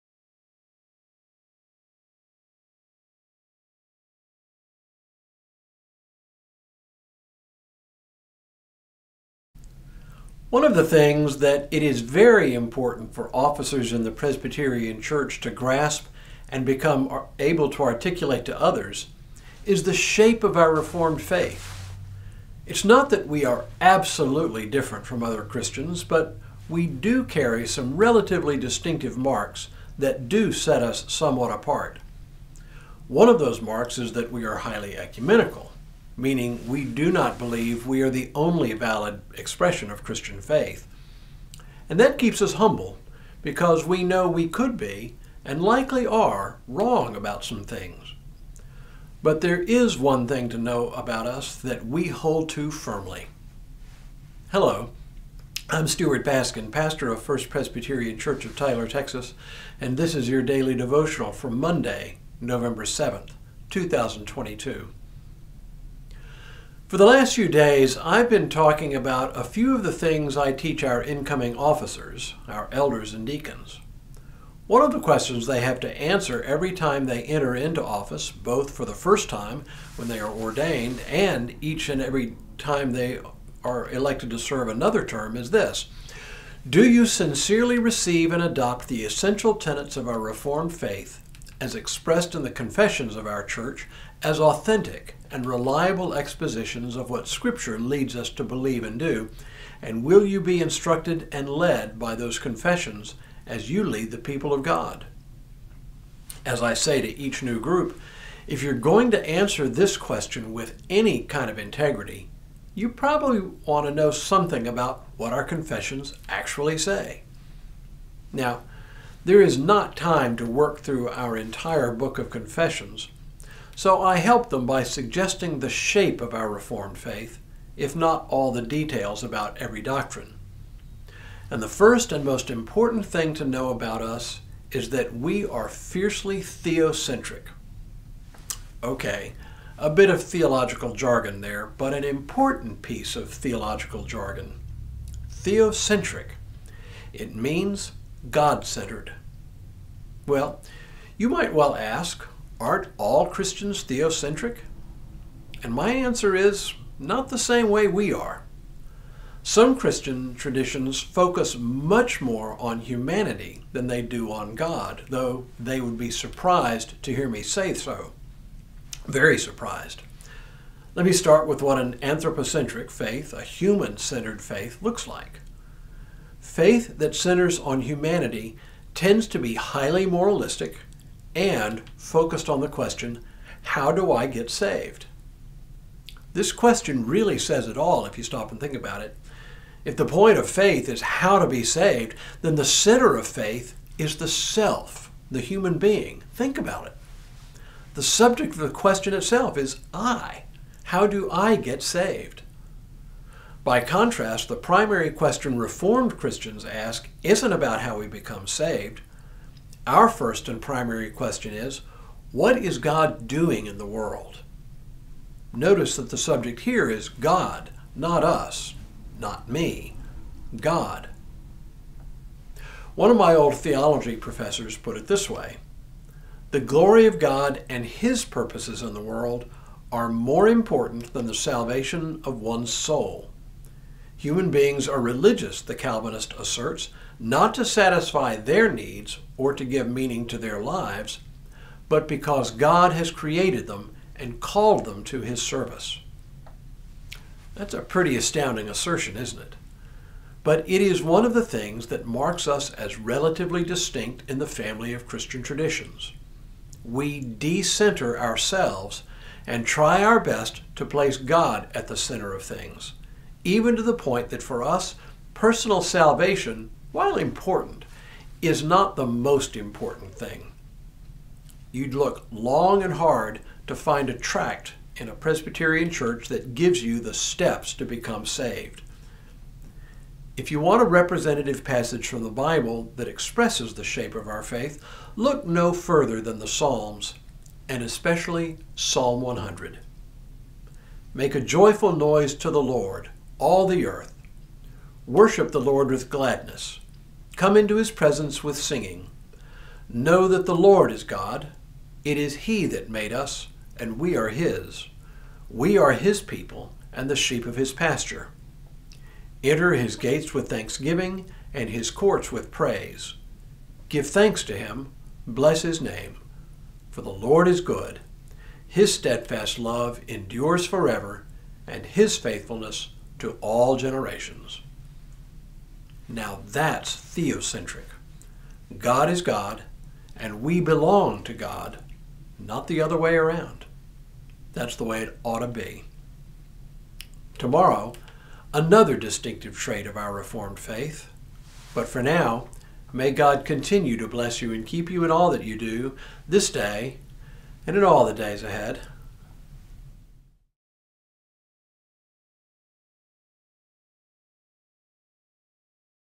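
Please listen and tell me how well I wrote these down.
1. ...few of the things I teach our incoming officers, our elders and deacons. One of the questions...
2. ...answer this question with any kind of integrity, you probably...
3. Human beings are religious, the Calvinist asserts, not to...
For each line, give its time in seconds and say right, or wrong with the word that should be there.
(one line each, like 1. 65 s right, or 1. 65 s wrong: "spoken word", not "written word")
1. 69 s right
2. 109 s right
3. 234 s right.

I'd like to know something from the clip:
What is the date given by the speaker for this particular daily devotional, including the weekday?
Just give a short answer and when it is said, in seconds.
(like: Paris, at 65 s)
Monday, November 7th, 2022, at 61 s.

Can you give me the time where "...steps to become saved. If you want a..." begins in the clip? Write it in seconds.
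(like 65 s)
277 s.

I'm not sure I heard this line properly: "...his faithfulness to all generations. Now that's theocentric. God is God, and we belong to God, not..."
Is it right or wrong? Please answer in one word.
right.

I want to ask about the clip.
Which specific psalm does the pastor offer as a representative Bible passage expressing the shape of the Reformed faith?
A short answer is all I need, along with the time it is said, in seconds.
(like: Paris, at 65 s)
Psalm 100, at 288 s.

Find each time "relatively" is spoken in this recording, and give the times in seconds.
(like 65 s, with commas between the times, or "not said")
27 s, 252 s.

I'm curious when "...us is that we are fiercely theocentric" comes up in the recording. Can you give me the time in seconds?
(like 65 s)
134 s.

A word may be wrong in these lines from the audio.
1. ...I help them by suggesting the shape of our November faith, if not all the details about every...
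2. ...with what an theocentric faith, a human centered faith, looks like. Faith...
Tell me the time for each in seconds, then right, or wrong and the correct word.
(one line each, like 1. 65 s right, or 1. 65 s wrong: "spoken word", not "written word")
1. 124 s wrong: "Reformed", not "November"
2. 171 s wrong: "anthropocentric", not "theocentric".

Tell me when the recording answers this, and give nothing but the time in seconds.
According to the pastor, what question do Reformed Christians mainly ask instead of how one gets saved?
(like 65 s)
212 s.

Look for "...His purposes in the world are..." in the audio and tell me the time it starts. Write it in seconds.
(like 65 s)
227 s.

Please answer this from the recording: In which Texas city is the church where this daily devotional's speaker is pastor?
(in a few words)
Tyler.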